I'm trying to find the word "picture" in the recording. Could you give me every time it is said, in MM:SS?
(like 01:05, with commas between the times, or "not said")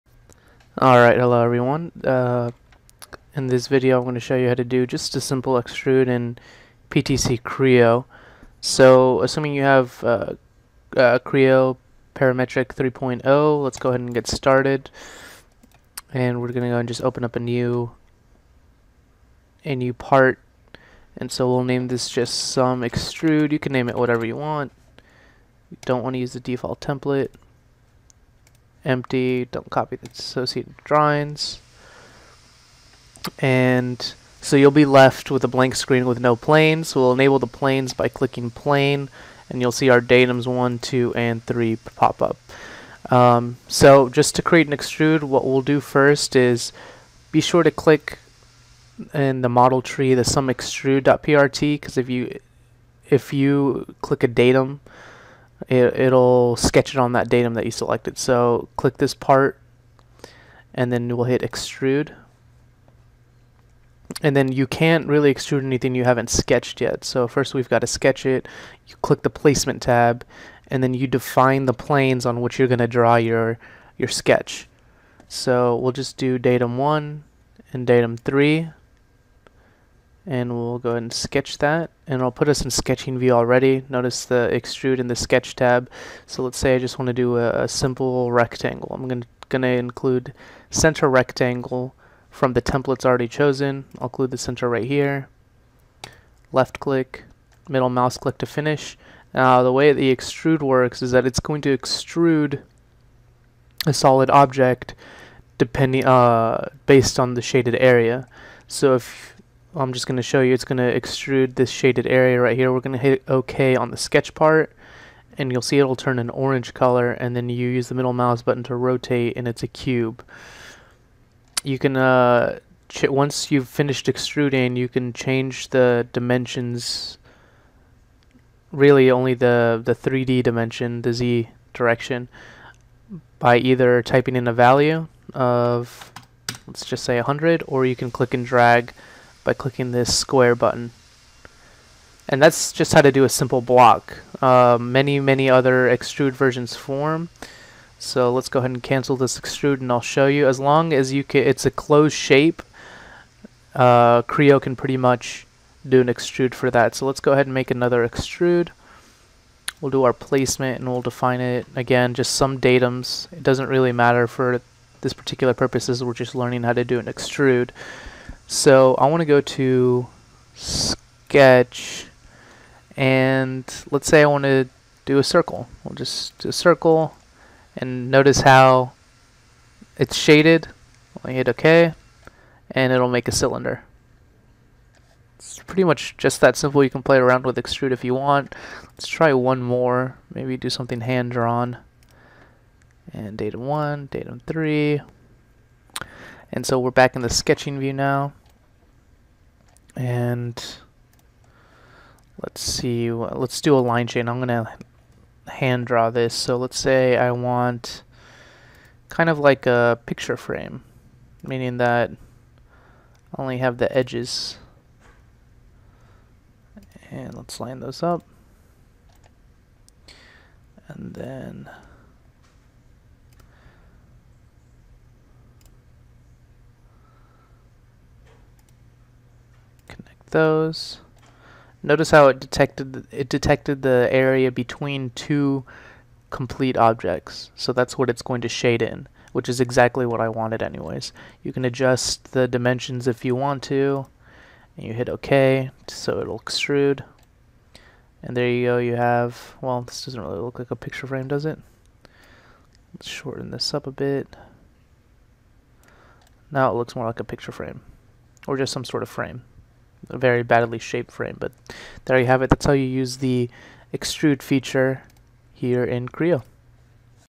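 03:30, 04:10, 04:17.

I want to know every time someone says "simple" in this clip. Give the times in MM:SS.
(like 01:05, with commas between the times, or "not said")
00:05, 01:27, 02:23, 03:06.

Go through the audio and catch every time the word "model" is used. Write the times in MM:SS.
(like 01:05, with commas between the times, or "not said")
00:49.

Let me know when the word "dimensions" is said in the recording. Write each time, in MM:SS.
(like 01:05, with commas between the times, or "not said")
02:06, 02:10, 04:02.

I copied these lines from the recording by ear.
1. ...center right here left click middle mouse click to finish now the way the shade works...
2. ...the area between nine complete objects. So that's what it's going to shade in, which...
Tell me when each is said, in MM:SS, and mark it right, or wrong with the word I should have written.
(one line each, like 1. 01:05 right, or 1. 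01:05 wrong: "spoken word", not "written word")
1. 01:34 wrong: "extrude", not "shade"
2. 03:53 wrong: "two", not "nine".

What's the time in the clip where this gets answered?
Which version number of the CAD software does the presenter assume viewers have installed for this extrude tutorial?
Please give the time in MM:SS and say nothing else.
00:12.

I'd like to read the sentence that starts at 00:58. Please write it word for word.
So click this part and then we'll hit extrude.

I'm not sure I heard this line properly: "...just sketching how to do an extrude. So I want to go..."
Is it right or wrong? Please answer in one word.
wrong.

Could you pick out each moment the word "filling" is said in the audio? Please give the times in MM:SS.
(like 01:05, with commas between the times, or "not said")
not said.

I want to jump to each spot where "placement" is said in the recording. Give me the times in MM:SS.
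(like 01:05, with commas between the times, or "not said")
01:09, 02:40.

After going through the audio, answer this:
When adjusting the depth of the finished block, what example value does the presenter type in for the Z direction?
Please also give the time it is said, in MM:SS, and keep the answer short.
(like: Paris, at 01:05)
100, at 02:17.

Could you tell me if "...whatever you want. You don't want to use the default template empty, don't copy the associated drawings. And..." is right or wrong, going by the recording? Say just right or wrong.
right.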